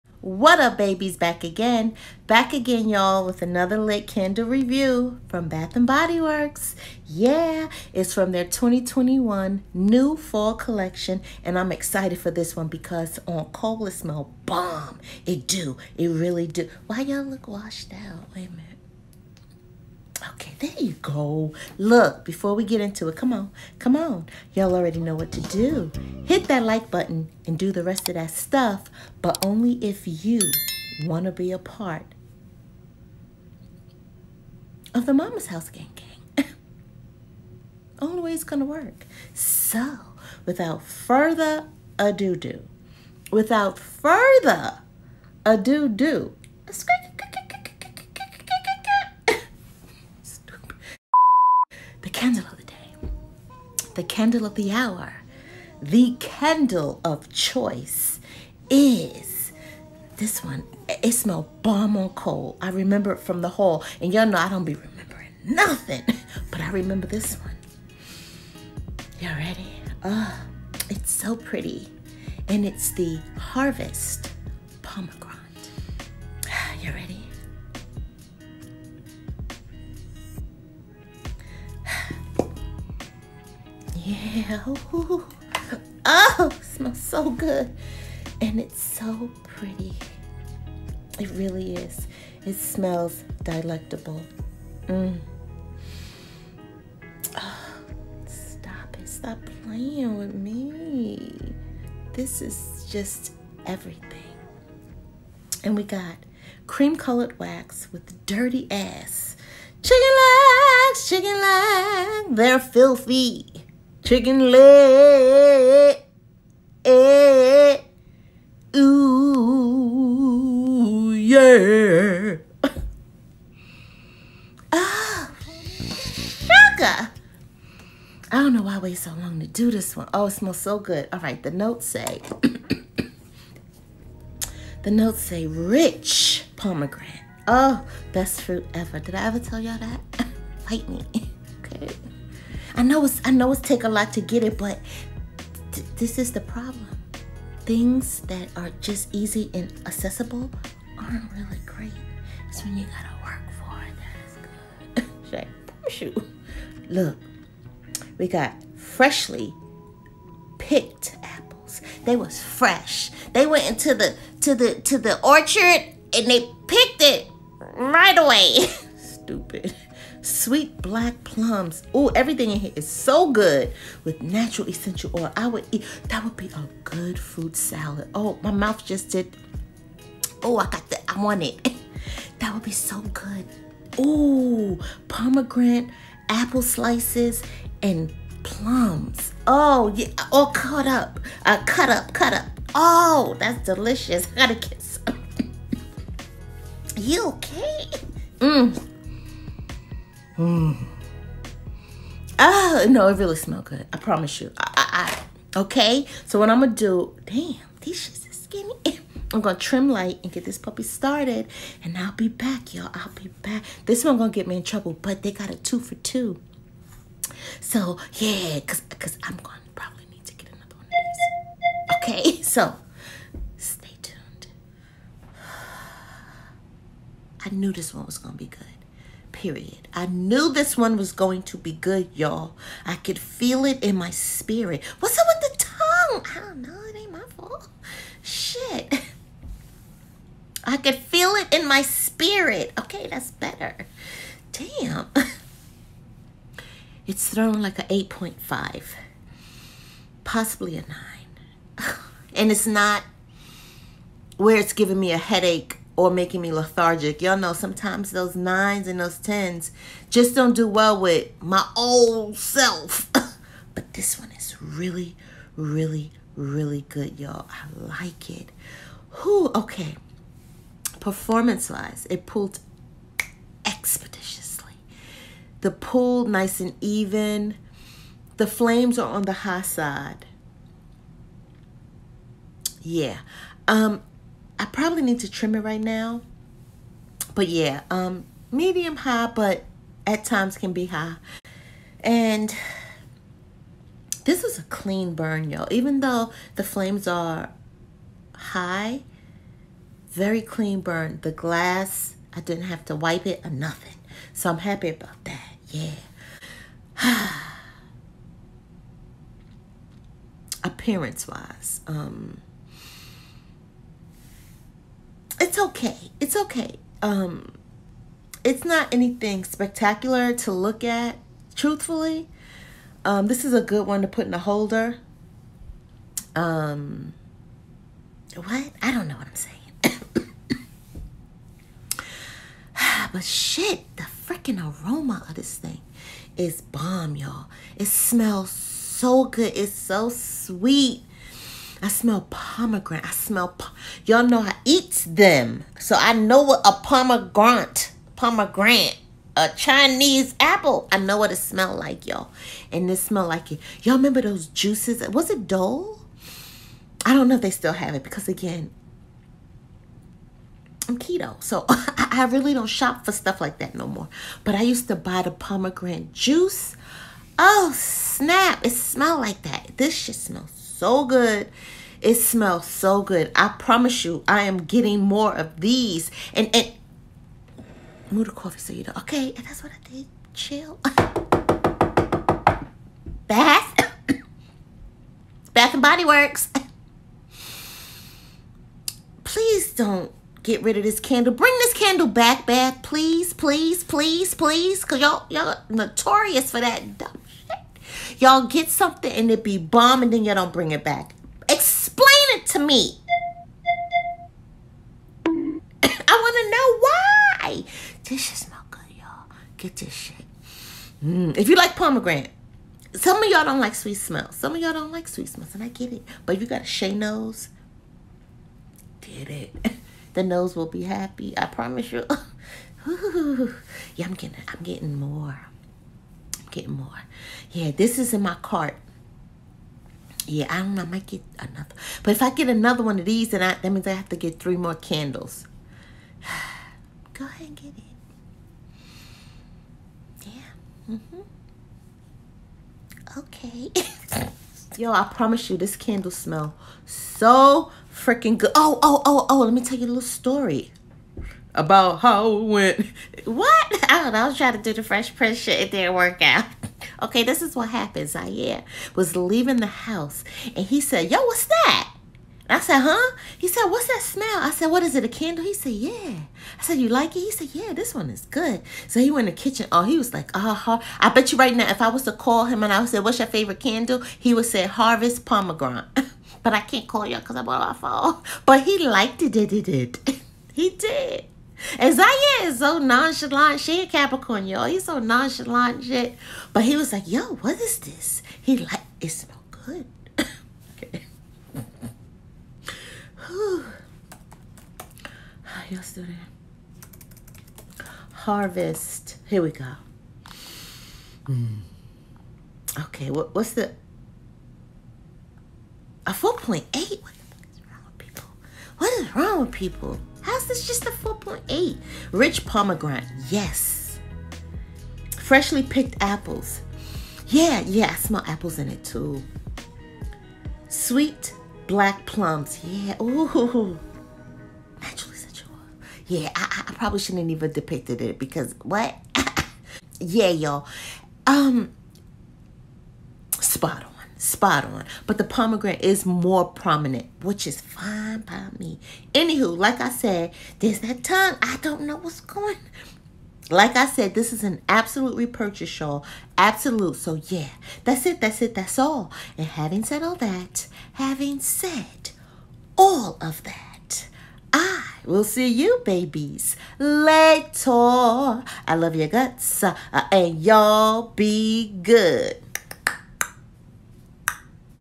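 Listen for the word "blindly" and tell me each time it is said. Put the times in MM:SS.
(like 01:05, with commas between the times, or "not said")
not said.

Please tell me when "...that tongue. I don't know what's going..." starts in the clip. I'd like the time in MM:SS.
09:00.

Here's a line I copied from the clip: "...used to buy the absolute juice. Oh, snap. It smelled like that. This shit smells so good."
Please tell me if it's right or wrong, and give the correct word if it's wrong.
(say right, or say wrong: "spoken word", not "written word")
wrong: "pomegranate", not "absolute".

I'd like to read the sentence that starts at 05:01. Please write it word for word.
The glass, I didn't have to wipe it or nothing.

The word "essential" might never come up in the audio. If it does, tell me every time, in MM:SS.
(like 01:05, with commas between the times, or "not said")
02:54.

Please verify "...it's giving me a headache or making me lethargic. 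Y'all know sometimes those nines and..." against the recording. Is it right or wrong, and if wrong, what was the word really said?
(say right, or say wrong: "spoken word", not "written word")
right.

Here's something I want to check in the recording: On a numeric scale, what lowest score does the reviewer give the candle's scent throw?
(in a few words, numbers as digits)
8.5.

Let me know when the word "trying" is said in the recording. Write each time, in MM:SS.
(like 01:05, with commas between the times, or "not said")
07:34.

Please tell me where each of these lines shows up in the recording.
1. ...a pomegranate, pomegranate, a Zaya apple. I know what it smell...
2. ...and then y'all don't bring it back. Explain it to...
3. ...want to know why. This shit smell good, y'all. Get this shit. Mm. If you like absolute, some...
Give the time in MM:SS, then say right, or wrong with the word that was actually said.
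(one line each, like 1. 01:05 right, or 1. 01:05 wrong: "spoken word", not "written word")
1. 05:46 wrong: "Chinese", not "Zaya"
2. 06:40 right
3. 06:45 wrong: "pomegranate", not "absolute".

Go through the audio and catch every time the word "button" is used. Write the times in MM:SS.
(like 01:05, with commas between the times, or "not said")
00:26.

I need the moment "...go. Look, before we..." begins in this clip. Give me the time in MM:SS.
00:21.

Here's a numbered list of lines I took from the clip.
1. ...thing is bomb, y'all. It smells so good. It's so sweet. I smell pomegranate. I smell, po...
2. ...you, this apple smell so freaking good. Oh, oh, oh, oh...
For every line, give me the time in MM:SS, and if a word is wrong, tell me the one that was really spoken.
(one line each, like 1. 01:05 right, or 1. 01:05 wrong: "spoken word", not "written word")
1. 05:35 right
2. 07:25 wrong: "candle", not "apple".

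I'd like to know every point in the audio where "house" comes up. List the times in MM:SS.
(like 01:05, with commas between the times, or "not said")
00:35, 07:39.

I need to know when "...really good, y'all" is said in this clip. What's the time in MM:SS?
04:26.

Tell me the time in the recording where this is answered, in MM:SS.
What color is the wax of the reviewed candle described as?
01:46.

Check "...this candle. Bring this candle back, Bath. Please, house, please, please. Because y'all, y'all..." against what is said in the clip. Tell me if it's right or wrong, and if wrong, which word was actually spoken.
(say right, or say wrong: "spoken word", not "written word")
wrong: "please", not "house".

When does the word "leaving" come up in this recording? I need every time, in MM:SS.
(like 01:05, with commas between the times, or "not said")
07:39.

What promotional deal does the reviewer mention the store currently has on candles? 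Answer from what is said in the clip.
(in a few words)
Two for two.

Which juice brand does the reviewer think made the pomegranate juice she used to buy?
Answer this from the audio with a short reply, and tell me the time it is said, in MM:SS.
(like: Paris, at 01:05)
Dole, at 05:55.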